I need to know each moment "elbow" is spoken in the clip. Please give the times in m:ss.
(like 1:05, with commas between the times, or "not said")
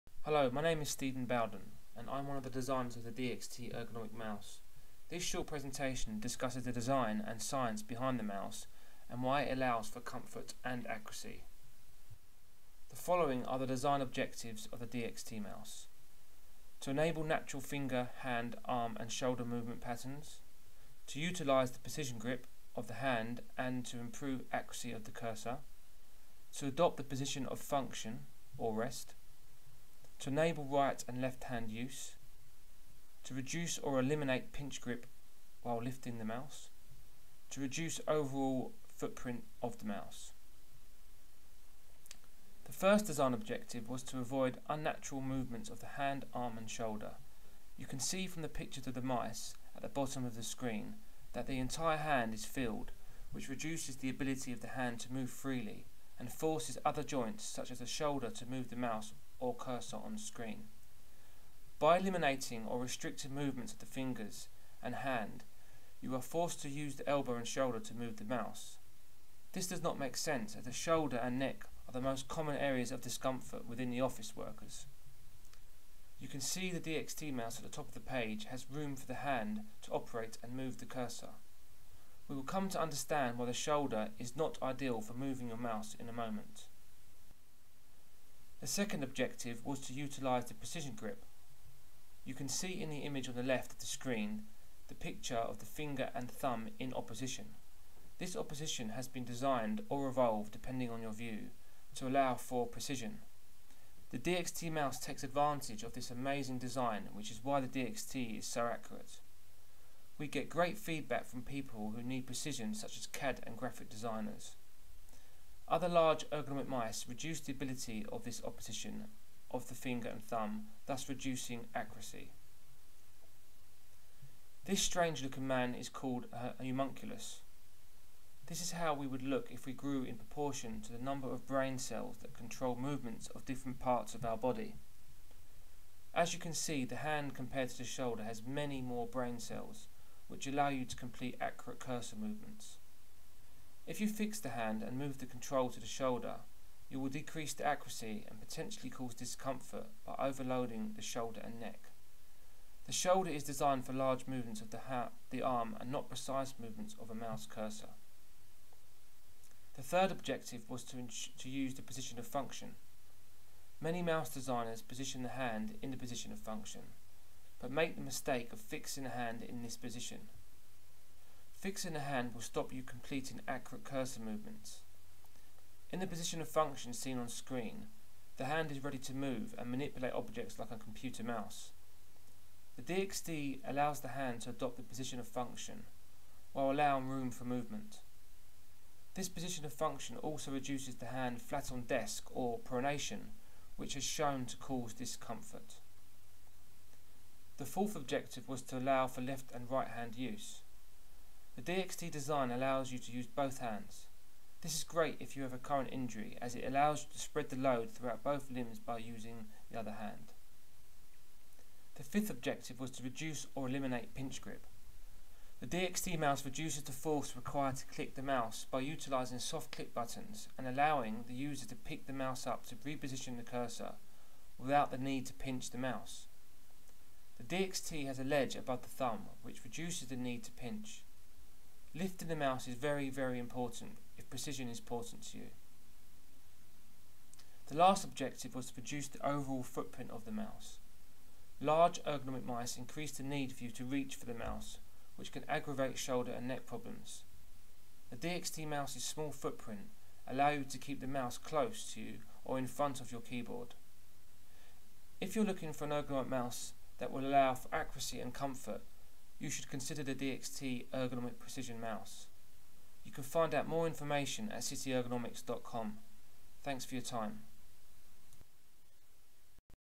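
1:07.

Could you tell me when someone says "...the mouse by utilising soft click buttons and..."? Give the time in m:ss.
3:38.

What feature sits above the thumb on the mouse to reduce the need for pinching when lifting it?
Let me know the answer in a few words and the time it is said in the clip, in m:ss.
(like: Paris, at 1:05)
a ledge, at 3:48.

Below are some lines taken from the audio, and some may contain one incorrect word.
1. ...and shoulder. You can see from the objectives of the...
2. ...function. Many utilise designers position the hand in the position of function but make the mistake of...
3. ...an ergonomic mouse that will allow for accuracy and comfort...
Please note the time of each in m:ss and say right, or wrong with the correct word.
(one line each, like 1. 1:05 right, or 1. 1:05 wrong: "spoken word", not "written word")
1. 0:46 wrong: "pictures", not "objectives"
2. 2:42 wrong: "mouse", not "utilise"
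3. 4:15 right.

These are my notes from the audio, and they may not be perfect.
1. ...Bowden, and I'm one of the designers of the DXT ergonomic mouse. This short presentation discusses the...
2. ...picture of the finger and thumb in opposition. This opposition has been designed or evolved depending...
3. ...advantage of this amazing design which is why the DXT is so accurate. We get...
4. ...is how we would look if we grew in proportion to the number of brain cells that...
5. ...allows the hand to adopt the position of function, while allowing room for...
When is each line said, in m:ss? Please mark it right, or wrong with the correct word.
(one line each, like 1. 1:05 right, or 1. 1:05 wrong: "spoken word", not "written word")
1. 0:01 right
2. 1:34 right
3. 1:45 right
4. 2:08 right
5. 3:03 right.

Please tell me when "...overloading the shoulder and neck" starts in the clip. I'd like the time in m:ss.
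2:30.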